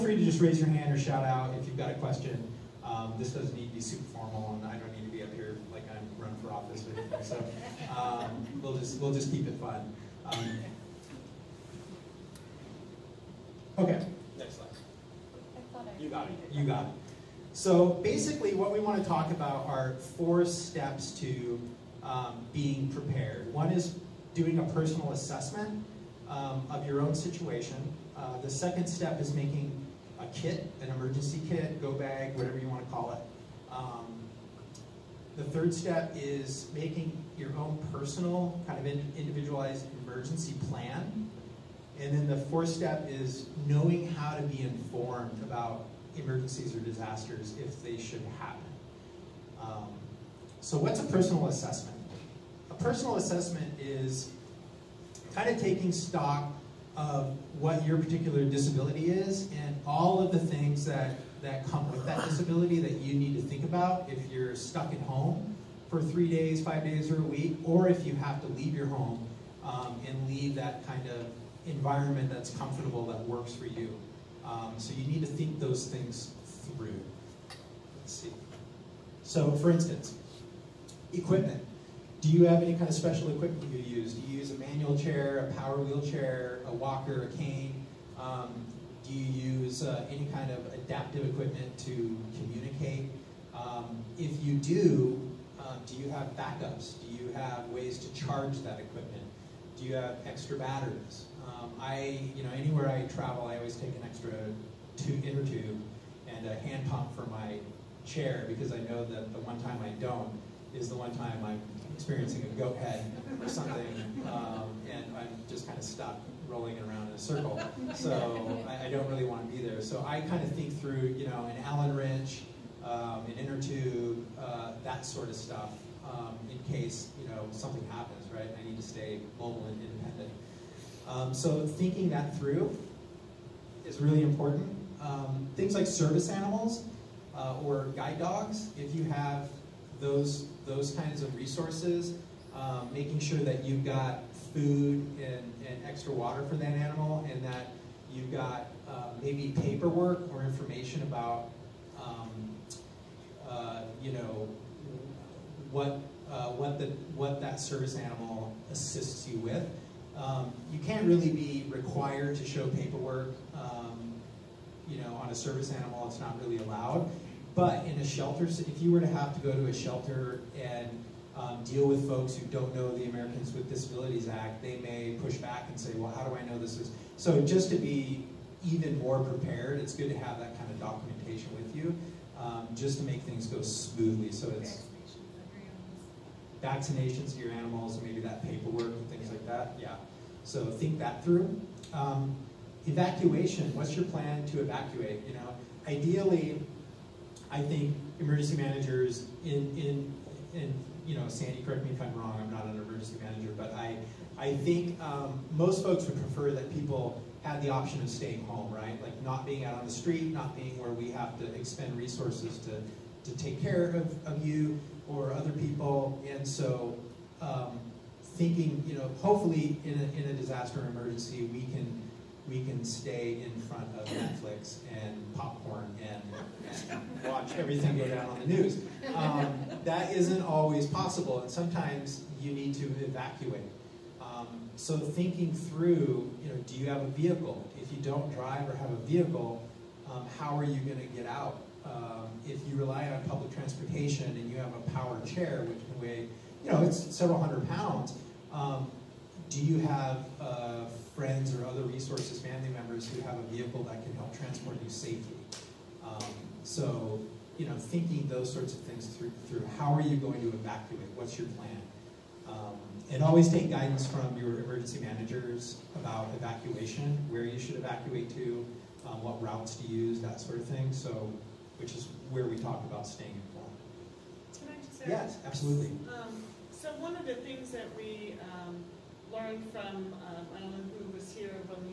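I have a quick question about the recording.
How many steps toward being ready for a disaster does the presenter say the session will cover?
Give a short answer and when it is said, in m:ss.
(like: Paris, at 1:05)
4, at 0:20.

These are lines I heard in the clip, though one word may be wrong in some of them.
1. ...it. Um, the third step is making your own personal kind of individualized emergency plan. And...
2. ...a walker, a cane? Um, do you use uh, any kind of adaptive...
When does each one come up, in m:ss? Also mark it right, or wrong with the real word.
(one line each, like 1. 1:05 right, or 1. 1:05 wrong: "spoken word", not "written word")
1. 0:33 right
2. 1:26 right.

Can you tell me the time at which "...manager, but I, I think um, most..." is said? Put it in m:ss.
3:23.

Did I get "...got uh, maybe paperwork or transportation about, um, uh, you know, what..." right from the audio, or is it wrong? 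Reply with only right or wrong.
wrong.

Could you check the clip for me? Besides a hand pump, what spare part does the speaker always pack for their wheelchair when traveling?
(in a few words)
An inner tube.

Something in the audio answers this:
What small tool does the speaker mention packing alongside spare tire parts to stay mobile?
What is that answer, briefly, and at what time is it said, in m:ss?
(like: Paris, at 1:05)
Allen wrench, at 2:01.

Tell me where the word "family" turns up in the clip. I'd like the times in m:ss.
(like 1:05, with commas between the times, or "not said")
4:12.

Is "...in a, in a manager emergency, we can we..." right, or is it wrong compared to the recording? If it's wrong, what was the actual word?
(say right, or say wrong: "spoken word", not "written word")
wrong: "disaster", not "manager".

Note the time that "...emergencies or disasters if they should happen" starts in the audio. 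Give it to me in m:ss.
0:46.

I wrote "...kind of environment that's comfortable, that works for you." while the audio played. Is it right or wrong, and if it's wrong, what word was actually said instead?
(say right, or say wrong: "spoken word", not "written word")
right.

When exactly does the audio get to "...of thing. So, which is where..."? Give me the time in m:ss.
4:30.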